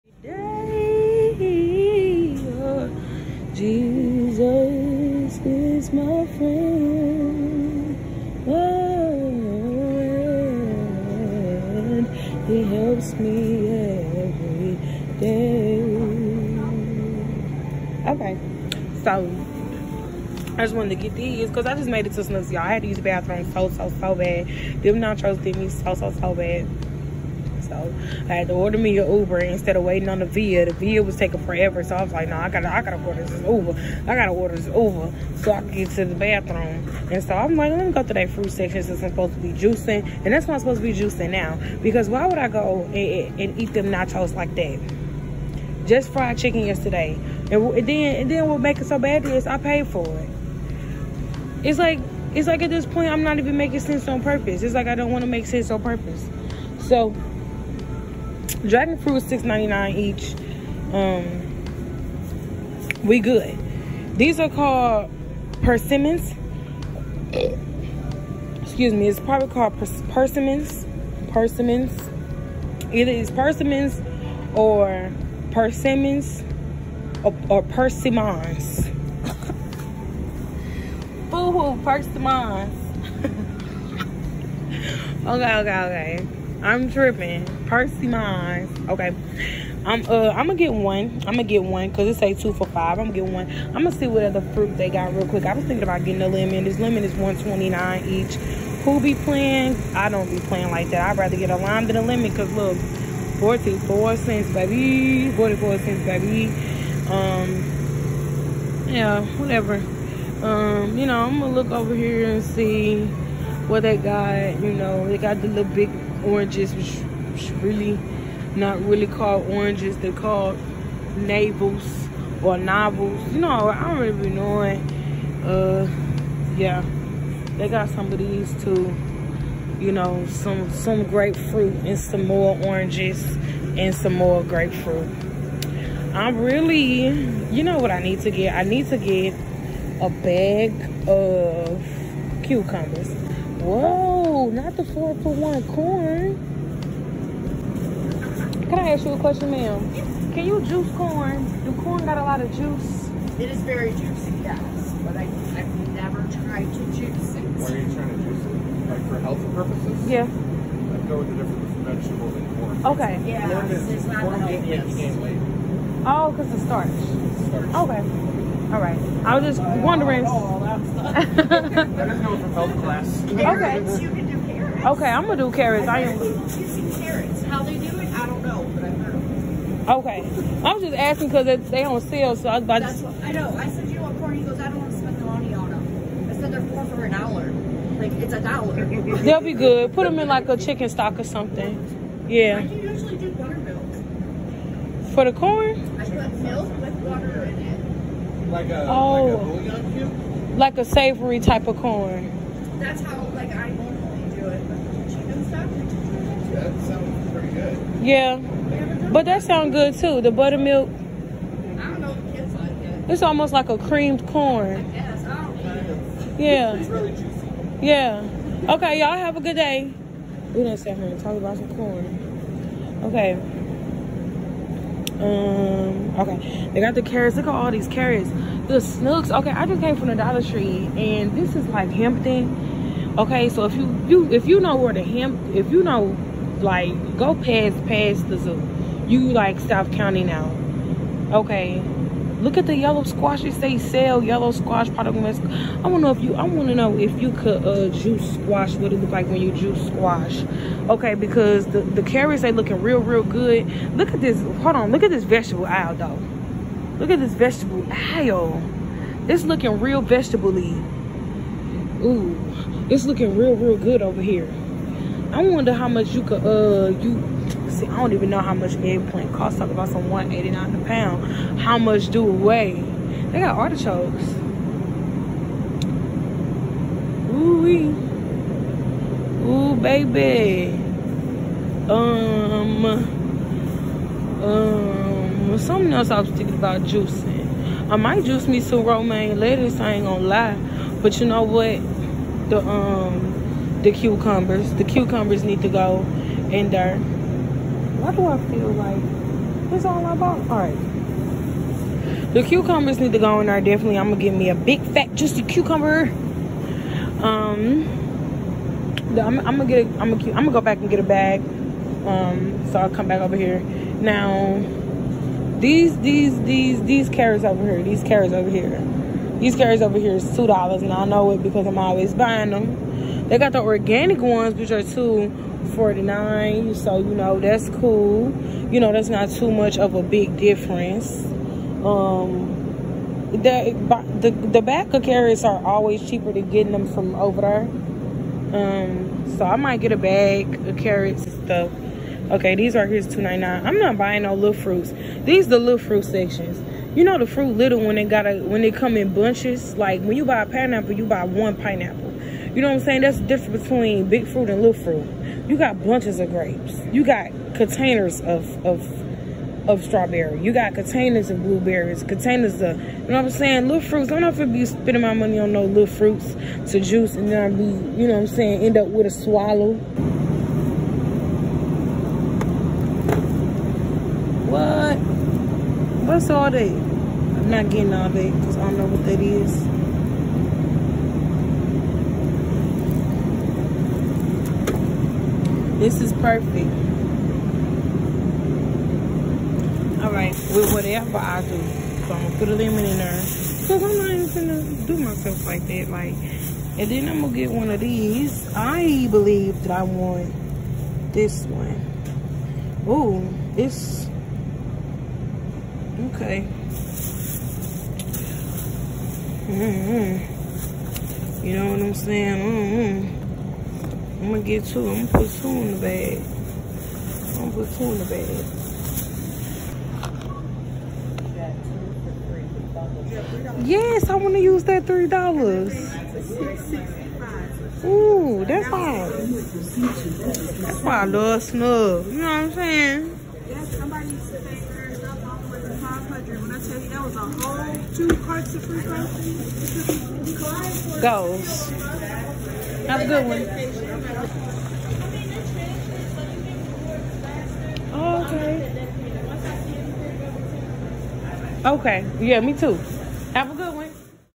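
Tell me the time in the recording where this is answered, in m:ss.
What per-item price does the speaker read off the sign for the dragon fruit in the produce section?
0:59.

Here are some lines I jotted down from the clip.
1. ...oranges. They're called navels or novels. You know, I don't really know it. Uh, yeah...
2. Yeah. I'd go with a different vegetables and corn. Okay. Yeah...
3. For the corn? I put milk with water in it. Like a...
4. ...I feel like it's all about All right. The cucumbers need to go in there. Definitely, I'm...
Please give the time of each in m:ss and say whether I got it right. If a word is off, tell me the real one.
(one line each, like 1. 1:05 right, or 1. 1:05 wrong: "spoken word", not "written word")
1. 1:59 right
2. 2:40 right
3. 3:15 right
4. 4:58 right.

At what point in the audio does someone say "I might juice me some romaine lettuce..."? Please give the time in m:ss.
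4:47.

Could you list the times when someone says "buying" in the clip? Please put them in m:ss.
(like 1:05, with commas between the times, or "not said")
5:22, 5:43.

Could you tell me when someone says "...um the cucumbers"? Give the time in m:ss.
4:52.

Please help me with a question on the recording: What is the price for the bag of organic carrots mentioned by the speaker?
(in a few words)
$2.49.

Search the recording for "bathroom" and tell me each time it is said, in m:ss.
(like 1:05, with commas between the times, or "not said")
0:23, 0:36.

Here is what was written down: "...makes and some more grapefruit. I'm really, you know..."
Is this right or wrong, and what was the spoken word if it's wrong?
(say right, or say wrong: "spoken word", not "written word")
wrong: "oranges", not "makes".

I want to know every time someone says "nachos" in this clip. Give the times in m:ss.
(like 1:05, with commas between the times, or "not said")
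0:24, 0:43.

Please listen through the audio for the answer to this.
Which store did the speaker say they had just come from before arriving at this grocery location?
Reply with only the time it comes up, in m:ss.
3:50.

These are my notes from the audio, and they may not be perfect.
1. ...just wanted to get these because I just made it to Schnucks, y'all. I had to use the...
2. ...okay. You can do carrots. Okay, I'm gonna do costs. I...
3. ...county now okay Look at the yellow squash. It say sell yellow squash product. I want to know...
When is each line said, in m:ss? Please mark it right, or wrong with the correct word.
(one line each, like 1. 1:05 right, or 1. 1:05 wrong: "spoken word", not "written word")
1. 0:20 right
2. 2:53 wrong: "carrots", not "costs"
3. 3:59 right.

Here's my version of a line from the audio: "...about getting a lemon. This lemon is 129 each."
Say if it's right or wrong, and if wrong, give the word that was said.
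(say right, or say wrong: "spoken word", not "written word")
right.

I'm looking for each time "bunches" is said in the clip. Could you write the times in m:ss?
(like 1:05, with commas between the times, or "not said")
5:49, 5:55.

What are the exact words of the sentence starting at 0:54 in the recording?
It's like I don't want to make sense on purpose.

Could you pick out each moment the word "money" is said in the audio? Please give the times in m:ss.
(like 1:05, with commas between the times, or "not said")
3:05, 6:05.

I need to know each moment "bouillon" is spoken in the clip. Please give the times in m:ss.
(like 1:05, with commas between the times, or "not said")
3:19.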